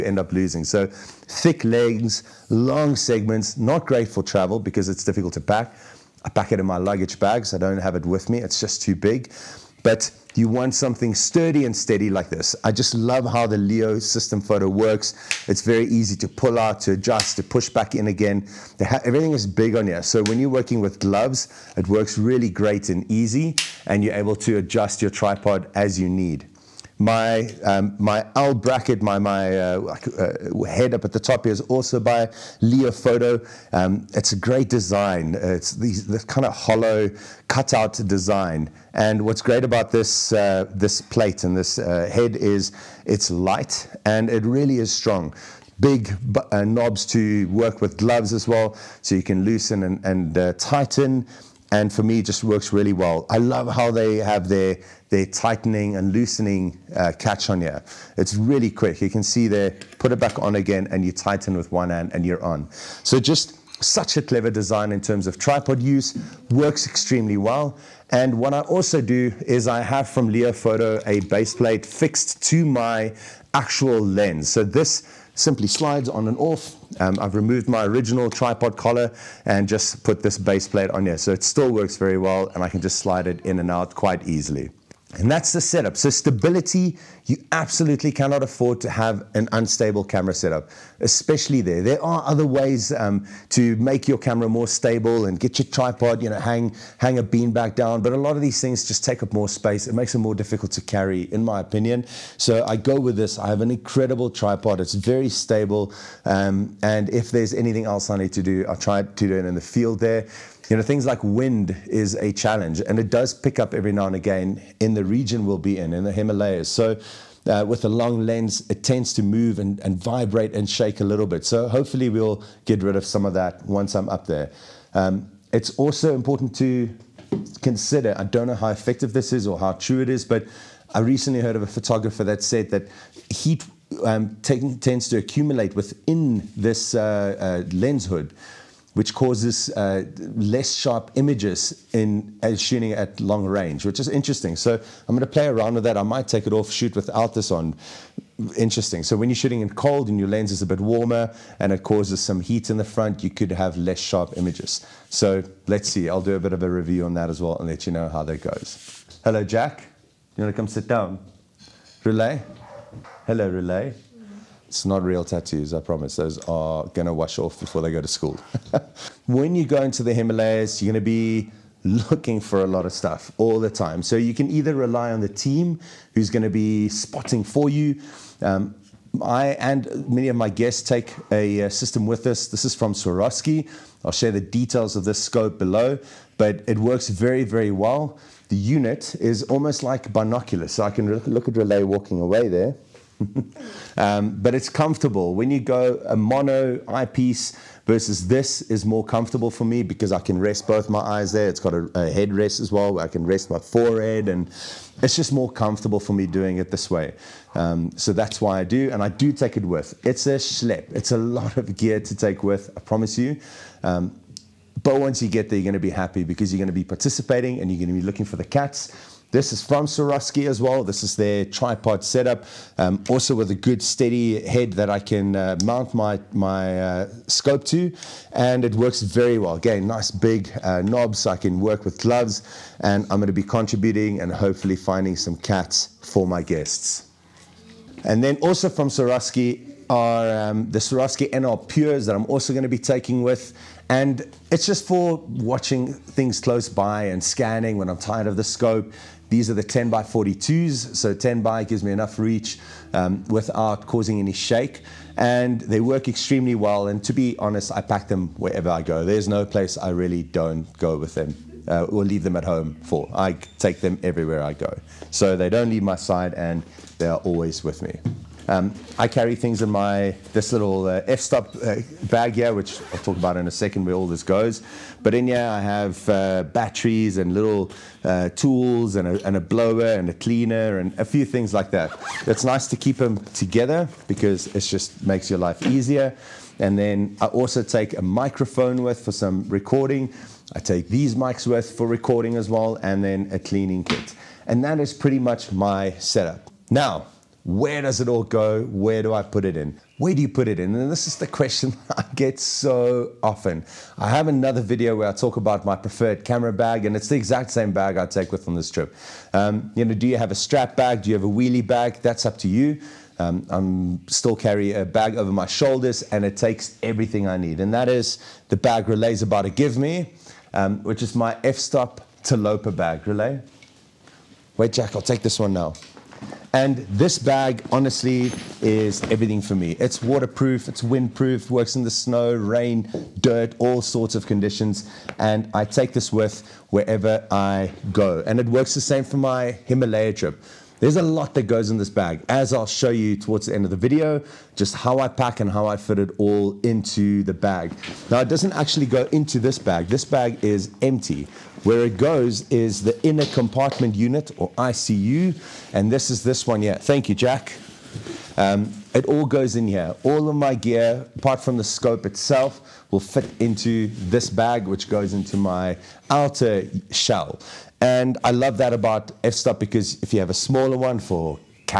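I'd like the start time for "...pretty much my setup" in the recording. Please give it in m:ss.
4:54.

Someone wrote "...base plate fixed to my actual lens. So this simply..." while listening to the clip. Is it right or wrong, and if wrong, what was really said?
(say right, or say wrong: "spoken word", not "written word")
right.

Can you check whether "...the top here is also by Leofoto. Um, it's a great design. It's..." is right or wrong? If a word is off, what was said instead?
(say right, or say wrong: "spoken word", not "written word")
right.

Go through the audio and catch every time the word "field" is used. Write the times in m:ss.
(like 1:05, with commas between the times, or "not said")
1:49.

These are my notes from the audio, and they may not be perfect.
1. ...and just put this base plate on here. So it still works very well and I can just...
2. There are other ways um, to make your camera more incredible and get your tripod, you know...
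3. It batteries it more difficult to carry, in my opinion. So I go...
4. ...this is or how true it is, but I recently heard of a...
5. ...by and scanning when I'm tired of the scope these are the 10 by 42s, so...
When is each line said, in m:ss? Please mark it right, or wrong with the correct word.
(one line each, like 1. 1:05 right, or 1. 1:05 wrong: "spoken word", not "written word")
1. 1:19 right
2. 1:31 wrong: "stable", not "incredible"
3. 1:39 wrong: "makes", not "batteries"
4. 2:09 right
5. 4:06 right.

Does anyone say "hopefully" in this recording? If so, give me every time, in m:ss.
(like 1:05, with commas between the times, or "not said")
2:01, 3:54.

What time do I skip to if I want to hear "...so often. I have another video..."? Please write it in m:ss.
5:02.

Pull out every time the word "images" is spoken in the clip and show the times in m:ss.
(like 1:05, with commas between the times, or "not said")
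2:21, 2:34.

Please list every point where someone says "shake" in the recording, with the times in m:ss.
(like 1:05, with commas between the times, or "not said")
2:00, 4:14.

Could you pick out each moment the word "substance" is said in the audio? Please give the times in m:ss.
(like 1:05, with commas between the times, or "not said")
not said.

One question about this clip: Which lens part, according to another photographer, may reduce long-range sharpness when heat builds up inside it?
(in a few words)
Lens hood.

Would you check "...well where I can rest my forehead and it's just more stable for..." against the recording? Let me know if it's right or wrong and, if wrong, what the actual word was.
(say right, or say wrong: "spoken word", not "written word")
wrong: "comfortable", not "stable".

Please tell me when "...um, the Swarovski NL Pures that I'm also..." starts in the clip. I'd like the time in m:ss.
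4:00.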